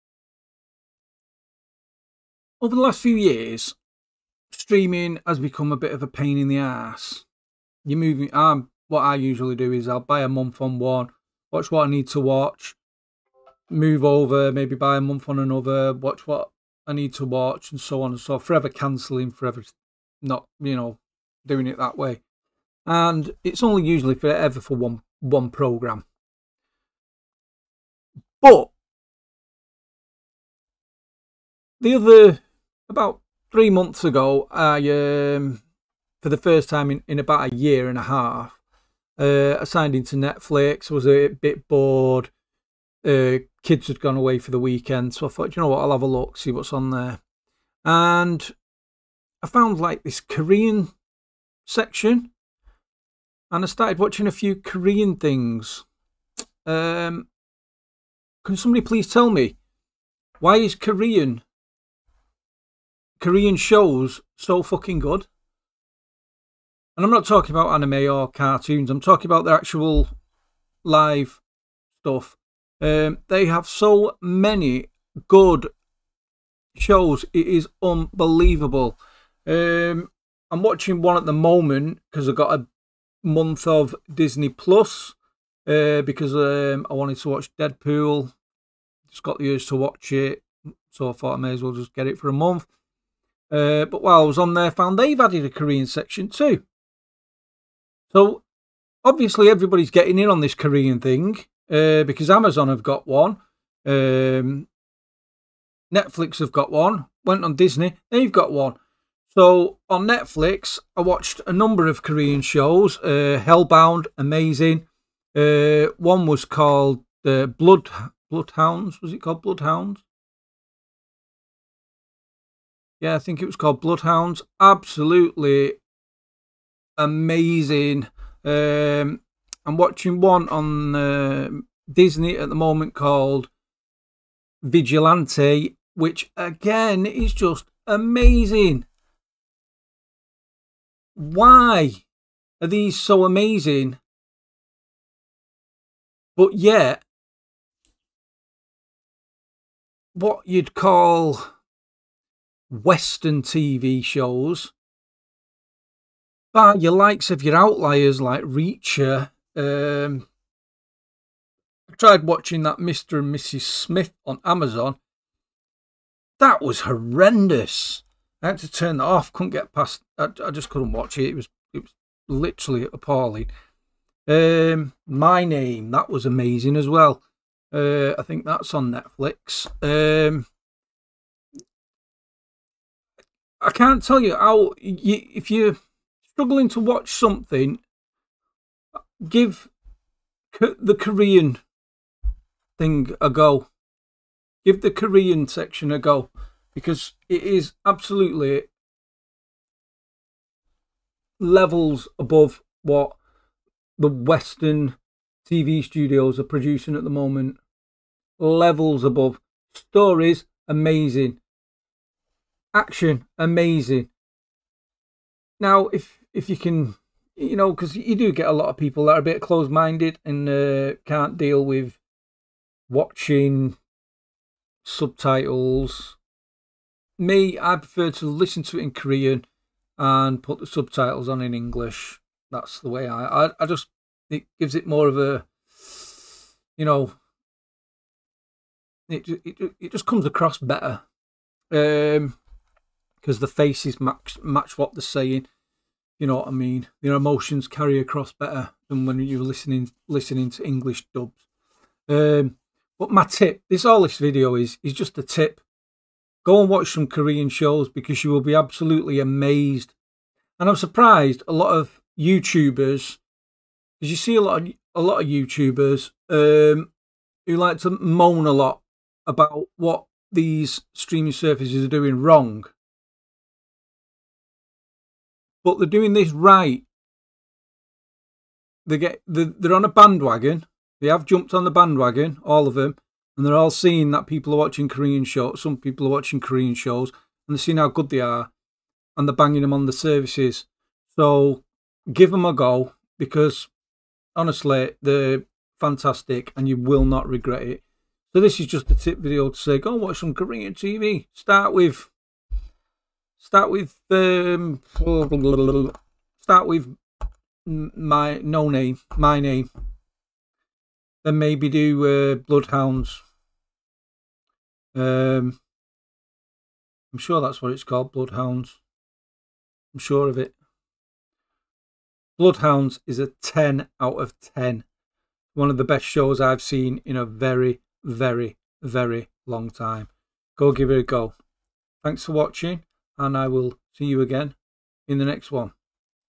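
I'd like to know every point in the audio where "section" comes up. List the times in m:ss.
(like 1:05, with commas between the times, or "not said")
0:51, 1:35, 3:15.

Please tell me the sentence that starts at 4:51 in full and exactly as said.
So give them a go because honestly, they're fantastic, and you will not regret it.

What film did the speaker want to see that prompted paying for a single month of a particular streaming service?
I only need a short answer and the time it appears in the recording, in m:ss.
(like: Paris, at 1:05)
Deadpool, at 1:27.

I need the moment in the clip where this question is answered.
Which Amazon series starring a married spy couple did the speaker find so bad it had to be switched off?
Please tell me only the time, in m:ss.
2:42.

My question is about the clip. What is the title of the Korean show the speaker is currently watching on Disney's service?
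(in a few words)
Vigilante.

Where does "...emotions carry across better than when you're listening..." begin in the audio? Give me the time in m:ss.
4:07.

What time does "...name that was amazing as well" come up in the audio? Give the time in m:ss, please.
2:55.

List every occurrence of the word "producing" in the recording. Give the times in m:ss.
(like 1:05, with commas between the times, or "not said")
3:26.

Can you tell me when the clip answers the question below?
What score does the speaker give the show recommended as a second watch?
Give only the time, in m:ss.
5:23.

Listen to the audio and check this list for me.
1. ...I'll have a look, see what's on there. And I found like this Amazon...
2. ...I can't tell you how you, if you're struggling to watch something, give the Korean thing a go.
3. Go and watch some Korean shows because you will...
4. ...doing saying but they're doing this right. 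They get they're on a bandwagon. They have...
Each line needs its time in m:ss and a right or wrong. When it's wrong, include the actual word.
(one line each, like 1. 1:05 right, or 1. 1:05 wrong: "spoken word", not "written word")
1. 0:45 wrong: "Korean", not "Amazon"
2. 3:03 right
3. 4:16 right
4. 4:31 wrong: "wrong", not "saying".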